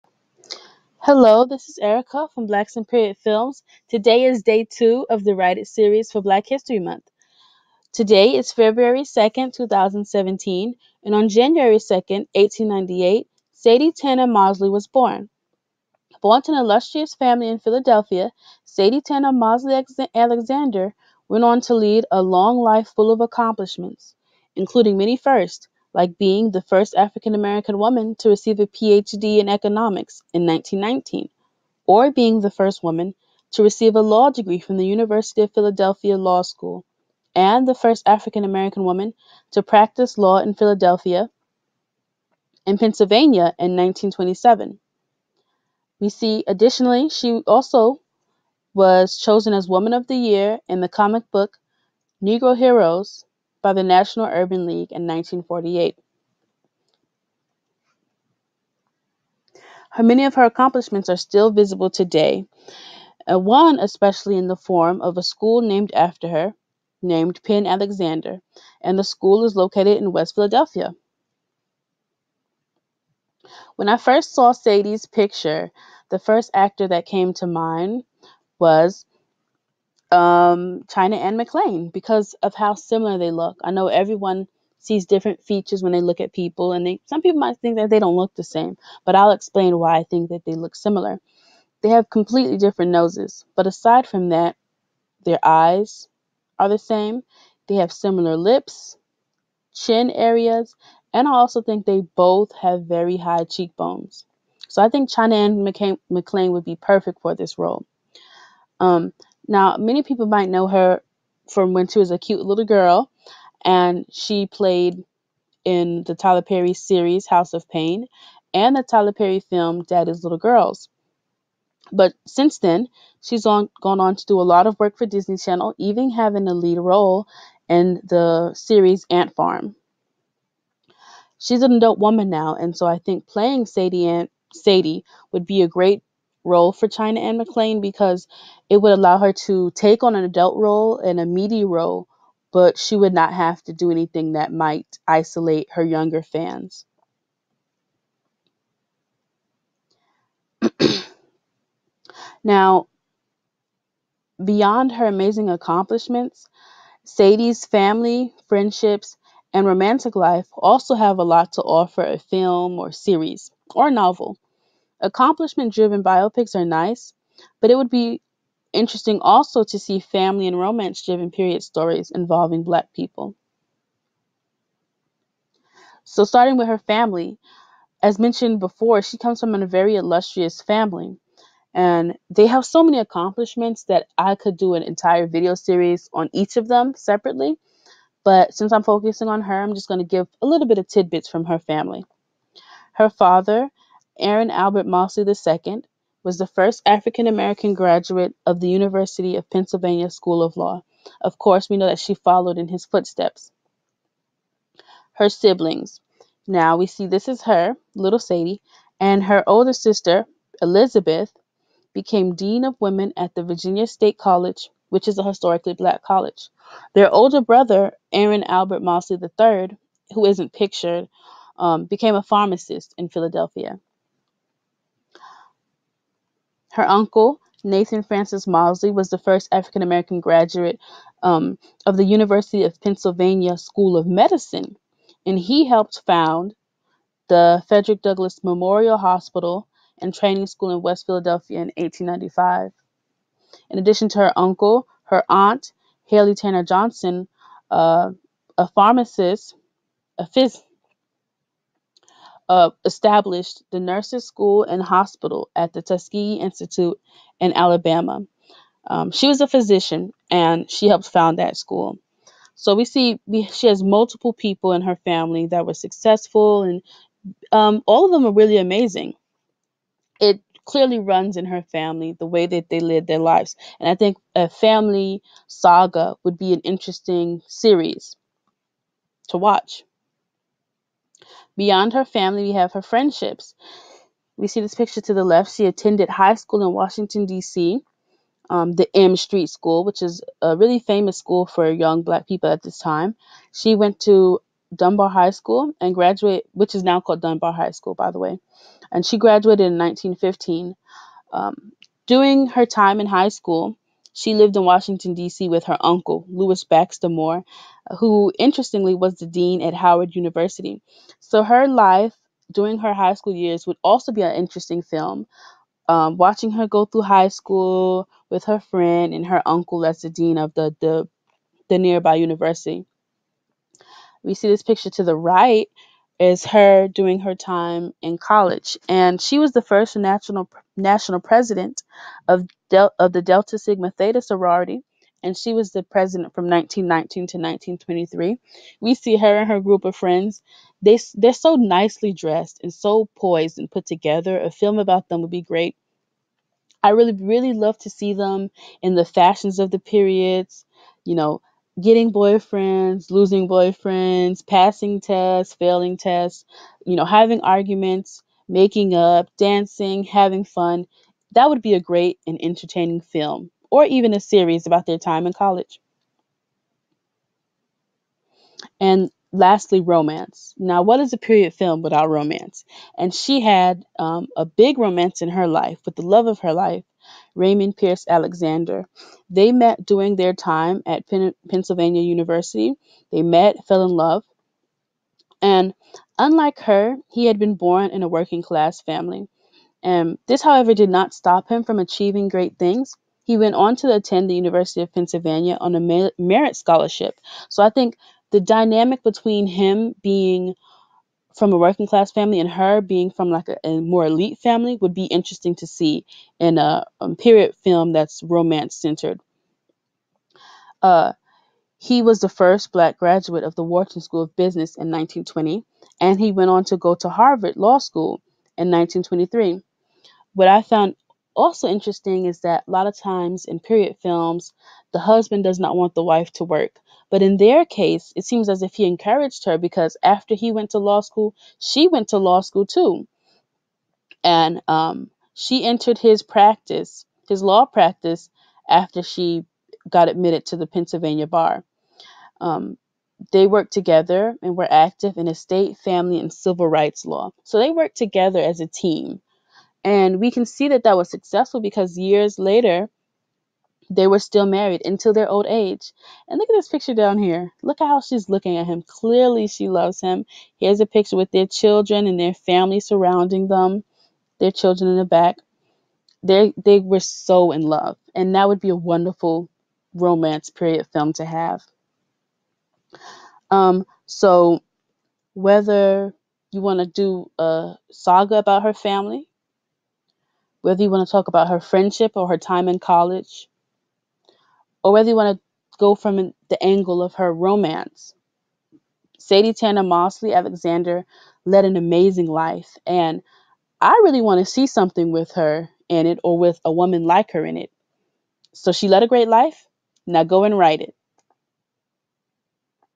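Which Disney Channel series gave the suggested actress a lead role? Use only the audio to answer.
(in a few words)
Ant Farm.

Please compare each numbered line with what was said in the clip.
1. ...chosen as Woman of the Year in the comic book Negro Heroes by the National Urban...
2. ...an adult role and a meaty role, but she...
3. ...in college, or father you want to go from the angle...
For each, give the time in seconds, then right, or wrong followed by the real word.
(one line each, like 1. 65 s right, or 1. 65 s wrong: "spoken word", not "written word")
1. 49 s right
2. 140 s right
3. 482 s wrong: "whether", not "father".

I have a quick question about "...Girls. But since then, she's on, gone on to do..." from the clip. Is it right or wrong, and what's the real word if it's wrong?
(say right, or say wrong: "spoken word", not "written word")
right.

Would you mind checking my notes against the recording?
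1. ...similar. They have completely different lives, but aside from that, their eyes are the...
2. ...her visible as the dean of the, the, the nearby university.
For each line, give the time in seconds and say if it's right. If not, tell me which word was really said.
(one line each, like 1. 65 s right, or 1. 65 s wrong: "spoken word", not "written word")
1. 90 s wrong: "noses", not "lives"
2. 319 s wrong: "uncle", not "visible".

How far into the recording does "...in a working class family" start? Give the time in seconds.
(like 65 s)
387 s.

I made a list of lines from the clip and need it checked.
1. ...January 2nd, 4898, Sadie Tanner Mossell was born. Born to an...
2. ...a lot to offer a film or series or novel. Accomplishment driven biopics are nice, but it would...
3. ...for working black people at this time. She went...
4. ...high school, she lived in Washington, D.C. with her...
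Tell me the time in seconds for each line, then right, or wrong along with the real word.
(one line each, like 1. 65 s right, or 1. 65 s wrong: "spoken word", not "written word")
1. 11 s wrong: "1898", not "4898"
2. 161 s right
3. 291 s wrong: "young", not "working"
4. 303 s right.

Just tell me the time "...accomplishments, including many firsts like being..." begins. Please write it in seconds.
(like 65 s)
23 s.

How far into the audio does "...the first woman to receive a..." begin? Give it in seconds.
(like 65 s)
32 s.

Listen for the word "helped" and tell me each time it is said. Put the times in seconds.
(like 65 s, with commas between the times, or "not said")
235 s, 260 s.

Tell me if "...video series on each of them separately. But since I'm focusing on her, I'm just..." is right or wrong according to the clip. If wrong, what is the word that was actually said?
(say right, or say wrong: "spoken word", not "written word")
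right.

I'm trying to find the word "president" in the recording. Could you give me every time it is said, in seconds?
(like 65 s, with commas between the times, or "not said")
331 s, 335 s.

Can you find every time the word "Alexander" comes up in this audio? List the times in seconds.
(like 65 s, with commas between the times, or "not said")
20 s, 67 s, 378 s, 490 s.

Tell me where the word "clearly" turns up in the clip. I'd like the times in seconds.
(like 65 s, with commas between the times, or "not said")
270 s, 458 s.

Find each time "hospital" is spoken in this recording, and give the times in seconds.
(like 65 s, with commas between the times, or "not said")
238 s, 254 s.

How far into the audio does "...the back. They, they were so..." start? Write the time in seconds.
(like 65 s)
464 s.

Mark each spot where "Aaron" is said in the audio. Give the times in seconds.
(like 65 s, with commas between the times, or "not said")
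194 s, 218 s.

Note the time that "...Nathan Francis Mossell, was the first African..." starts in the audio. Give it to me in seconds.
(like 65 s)
227 s.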